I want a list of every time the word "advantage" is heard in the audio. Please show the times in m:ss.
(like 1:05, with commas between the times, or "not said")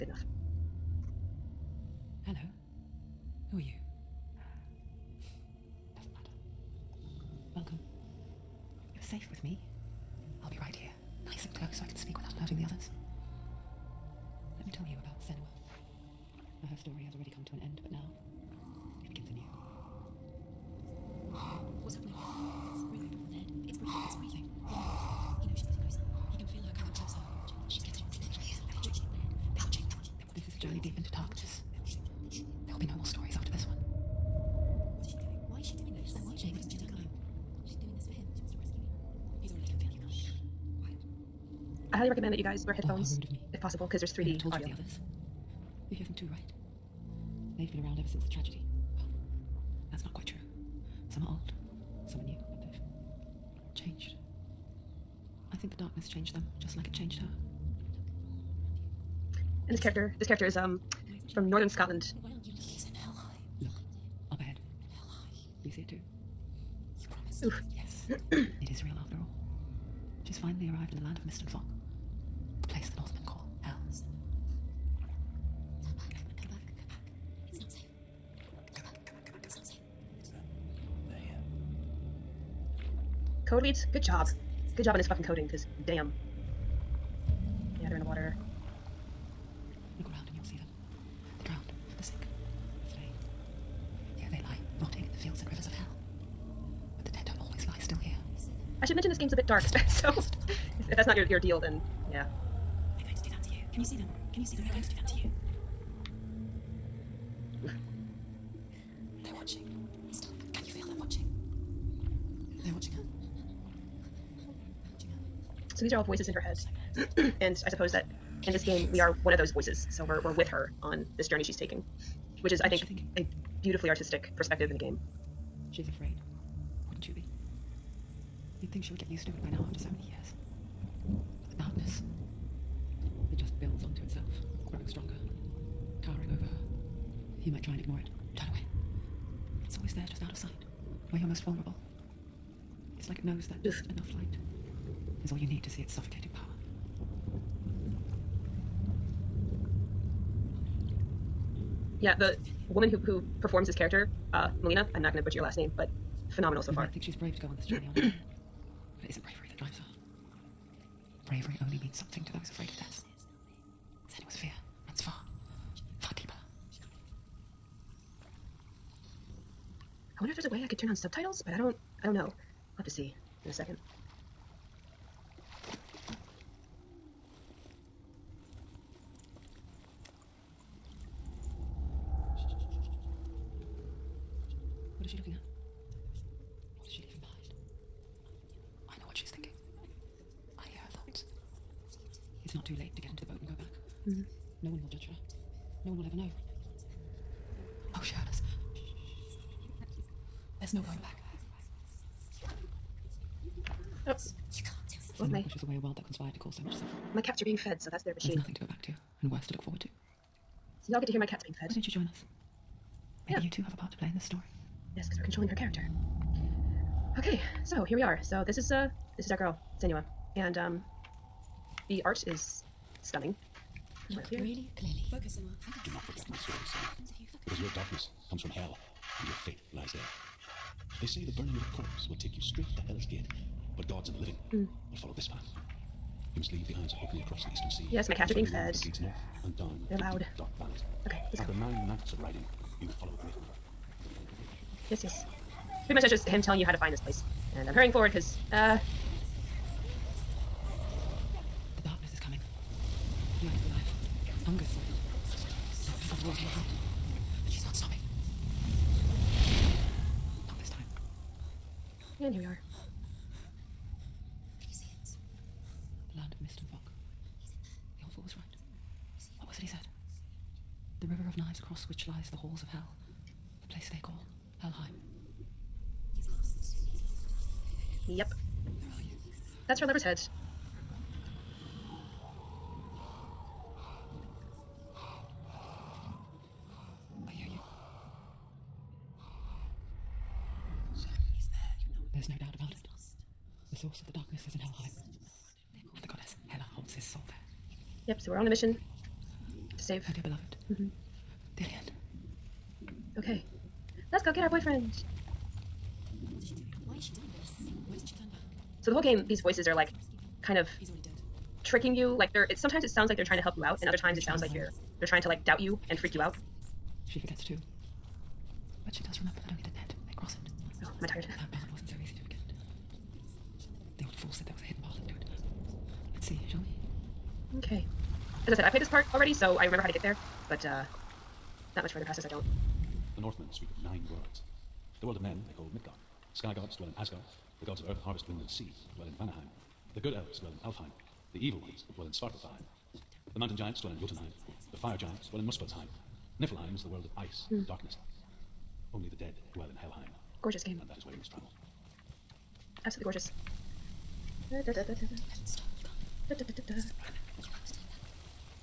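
not said.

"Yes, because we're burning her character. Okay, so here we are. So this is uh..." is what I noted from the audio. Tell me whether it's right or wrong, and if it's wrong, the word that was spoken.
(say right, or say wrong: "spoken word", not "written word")
wrong: "controlling", not "burning".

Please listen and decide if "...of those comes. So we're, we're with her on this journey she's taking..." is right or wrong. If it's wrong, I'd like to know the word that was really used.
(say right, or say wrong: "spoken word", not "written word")
wrong: "voices", not "comes".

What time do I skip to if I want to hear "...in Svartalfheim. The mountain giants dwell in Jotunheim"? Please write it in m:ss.
5:42.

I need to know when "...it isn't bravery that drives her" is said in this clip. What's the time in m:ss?
2:39.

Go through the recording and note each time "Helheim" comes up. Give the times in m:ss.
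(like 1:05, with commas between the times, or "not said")
4:34, 5:49.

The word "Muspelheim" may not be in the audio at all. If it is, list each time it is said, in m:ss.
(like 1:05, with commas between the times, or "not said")
5:45.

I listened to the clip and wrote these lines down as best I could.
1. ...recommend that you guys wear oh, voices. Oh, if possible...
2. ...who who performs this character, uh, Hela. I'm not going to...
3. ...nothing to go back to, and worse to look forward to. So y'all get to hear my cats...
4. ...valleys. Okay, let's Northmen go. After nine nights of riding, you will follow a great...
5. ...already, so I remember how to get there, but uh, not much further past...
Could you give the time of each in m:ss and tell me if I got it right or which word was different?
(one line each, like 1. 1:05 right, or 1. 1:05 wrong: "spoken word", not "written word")
1. 0:42 wrong: "headphones", not "voices"
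2. 2:32 wrong: "Melina", not "Hela"
3. 3:28 right
4. 4:00 wrong: "After", not "Northmen"
5. 5:29 right.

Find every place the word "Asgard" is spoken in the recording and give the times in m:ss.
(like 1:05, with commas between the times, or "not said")
5:36.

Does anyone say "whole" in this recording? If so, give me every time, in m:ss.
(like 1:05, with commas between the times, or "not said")
5:08.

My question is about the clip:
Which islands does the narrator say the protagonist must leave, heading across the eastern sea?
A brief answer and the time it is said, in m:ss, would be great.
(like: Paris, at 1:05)
Isles of Orkney, at 3:56.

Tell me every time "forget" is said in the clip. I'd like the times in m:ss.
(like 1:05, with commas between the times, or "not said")
3:45, 5:17, 5:22.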